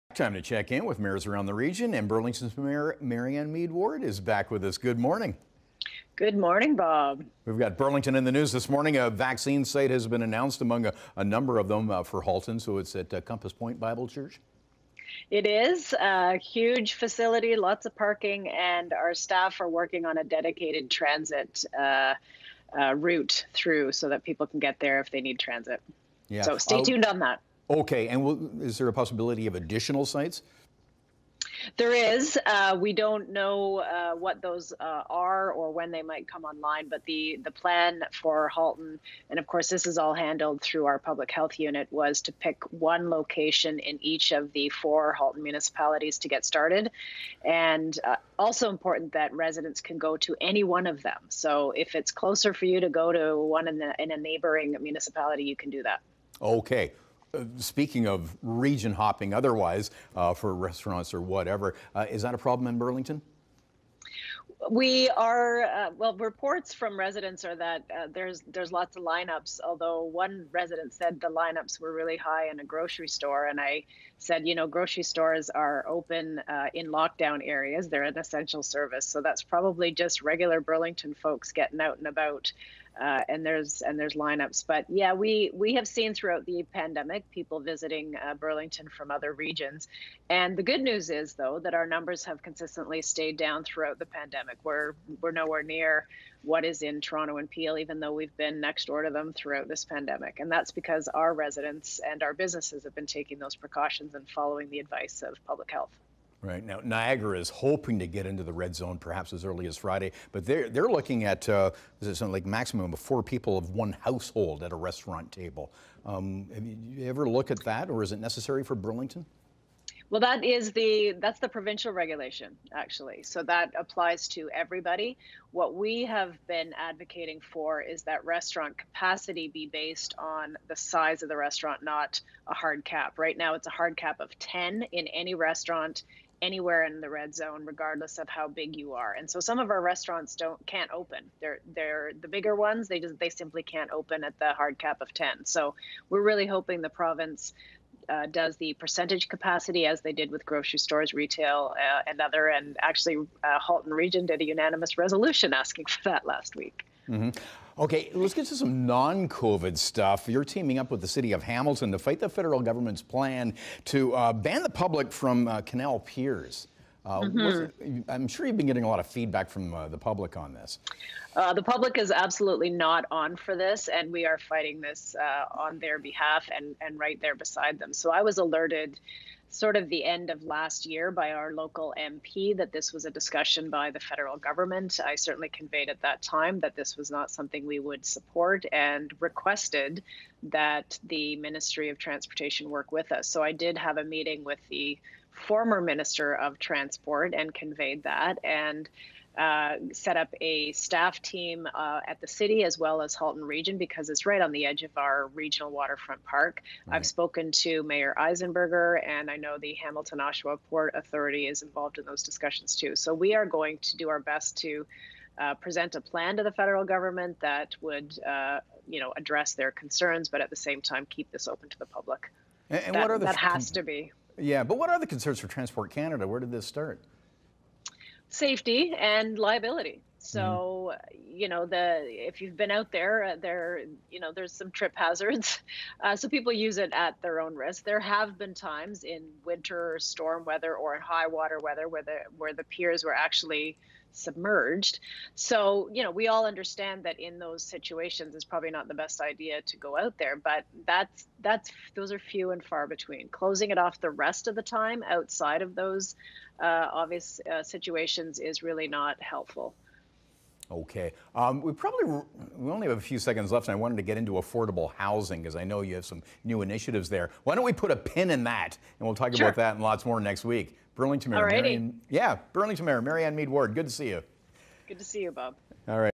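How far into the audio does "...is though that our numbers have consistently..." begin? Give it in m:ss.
1:31.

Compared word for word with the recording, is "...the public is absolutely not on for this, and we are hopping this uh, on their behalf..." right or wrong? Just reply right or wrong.
wrong.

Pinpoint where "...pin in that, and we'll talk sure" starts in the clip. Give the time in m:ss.
4:27.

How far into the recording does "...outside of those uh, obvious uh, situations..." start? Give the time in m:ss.
4:15.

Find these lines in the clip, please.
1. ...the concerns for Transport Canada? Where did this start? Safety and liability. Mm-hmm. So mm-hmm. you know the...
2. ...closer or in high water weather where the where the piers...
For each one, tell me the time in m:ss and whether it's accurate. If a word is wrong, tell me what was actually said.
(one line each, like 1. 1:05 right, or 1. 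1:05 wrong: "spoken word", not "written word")
1. 3:44 right
2. 4:00 wrong: "weather", not "closer".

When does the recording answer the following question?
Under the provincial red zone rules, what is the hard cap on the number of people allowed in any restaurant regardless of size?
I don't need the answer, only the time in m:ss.
2:13.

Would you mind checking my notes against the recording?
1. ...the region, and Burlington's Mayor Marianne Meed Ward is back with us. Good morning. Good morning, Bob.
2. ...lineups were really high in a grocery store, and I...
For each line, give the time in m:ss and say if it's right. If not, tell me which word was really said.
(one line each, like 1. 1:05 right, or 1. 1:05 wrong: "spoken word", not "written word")
1. 0:01 right
2. 1:11 right.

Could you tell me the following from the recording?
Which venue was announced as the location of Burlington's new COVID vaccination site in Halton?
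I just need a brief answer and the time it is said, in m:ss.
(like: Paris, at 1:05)
Compass Point Bible Church, at 0:13.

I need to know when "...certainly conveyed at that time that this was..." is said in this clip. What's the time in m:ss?
3:05.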